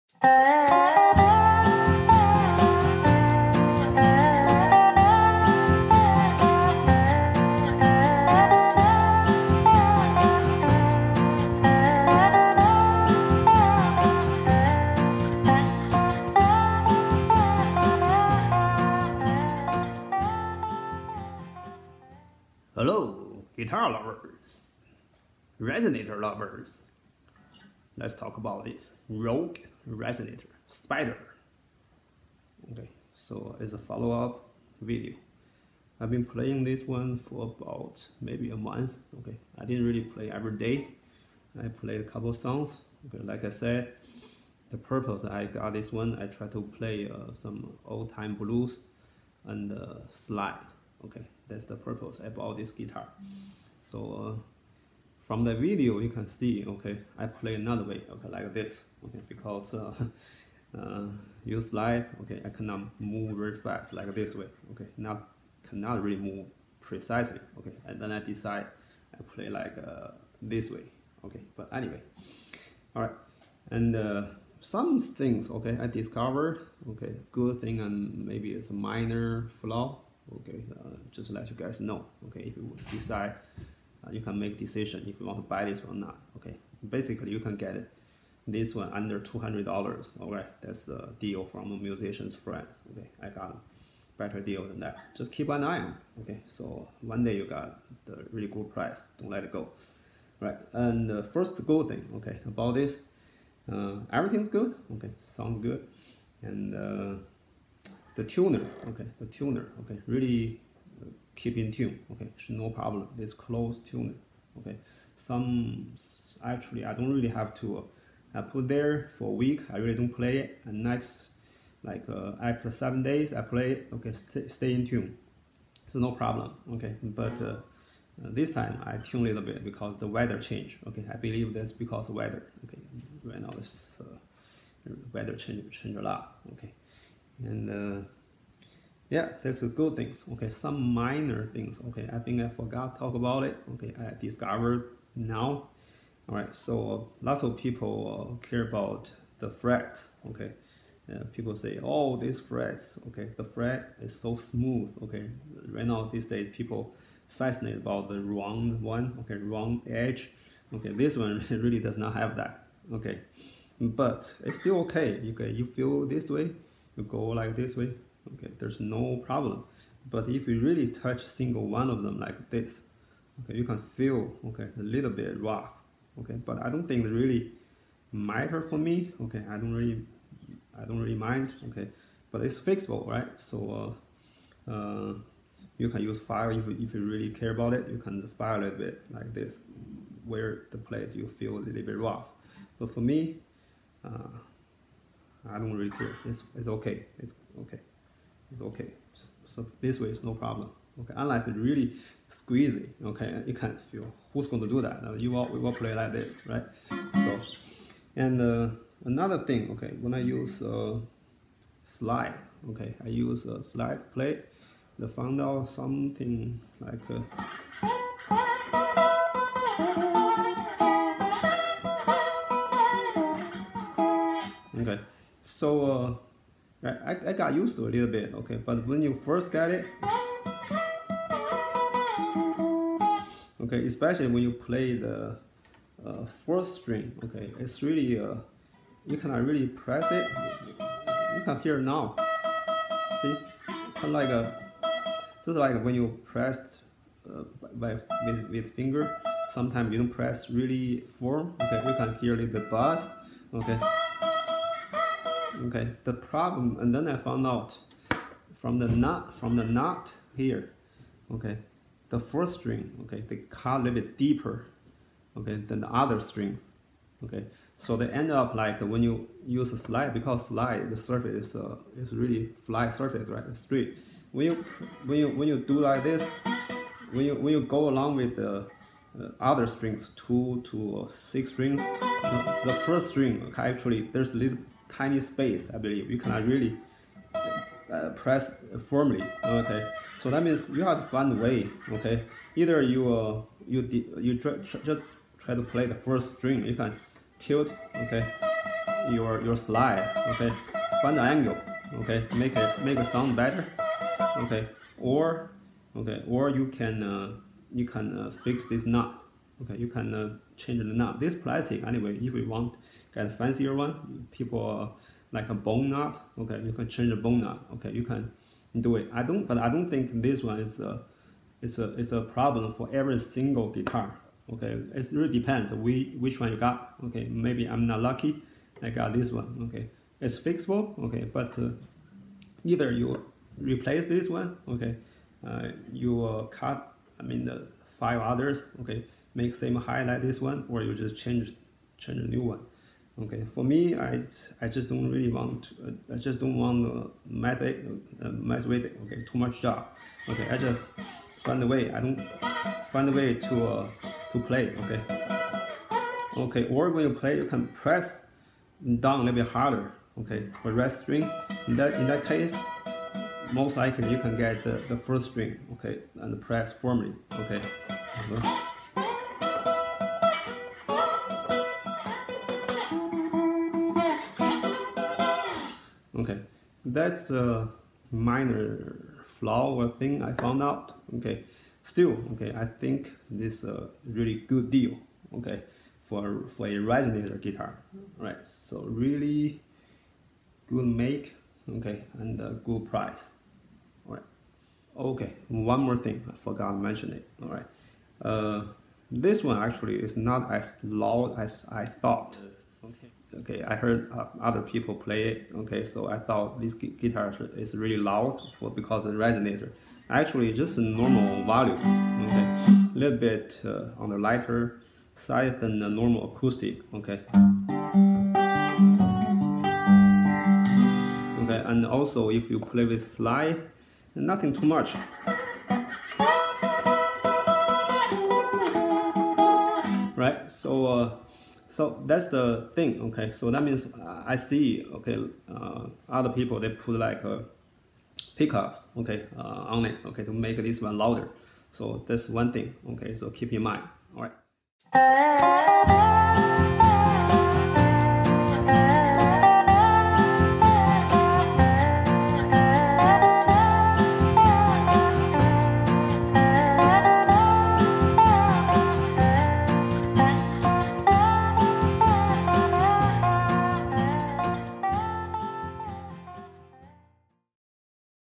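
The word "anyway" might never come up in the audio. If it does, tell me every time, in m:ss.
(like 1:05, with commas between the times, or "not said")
1:11, 5:11.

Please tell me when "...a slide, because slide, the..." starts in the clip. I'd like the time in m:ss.
4:29.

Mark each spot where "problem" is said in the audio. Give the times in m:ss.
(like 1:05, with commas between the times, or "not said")
1:52, 2:06, 2:49, 3:20, 4:16, 5:22.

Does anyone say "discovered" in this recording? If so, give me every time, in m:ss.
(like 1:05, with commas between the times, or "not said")
1:15, 2:24.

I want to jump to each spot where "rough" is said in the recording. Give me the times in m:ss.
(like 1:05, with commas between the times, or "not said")
2:55, 3:11.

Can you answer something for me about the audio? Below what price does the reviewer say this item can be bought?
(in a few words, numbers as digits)
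$200.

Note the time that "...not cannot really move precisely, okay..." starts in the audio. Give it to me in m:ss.
1:04.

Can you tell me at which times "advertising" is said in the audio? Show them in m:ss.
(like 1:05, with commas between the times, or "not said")
not said.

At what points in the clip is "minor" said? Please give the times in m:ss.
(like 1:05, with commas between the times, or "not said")
1:18, 2:20, 6:18.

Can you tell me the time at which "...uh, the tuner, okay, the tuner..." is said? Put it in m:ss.
1:46.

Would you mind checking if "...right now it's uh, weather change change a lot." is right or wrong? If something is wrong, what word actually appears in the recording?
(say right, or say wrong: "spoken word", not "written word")
right.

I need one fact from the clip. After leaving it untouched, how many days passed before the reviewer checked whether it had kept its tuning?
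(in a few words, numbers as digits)
7.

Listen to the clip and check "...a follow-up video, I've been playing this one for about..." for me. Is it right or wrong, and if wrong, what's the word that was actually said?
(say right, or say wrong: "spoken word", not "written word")
right.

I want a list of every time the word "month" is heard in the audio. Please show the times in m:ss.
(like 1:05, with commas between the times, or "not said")
0:38.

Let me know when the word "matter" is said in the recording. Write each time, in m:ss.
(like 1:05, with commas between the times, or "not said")
2:58.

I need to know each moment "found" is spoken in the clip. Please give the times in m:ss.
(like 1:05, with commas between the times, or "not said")
3:35, 4:17, 6:20.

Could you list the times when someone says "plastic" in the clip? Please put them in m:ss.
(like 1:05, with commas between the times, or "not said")
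5:11.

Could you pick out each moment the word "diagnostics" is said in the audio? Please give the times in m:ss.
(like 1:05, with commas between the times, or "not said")
not said.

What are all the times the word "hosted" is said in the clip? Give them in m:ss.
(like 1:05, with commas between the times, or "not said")
not said.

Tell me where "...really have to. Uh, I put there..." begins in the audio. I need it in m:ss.
1:57.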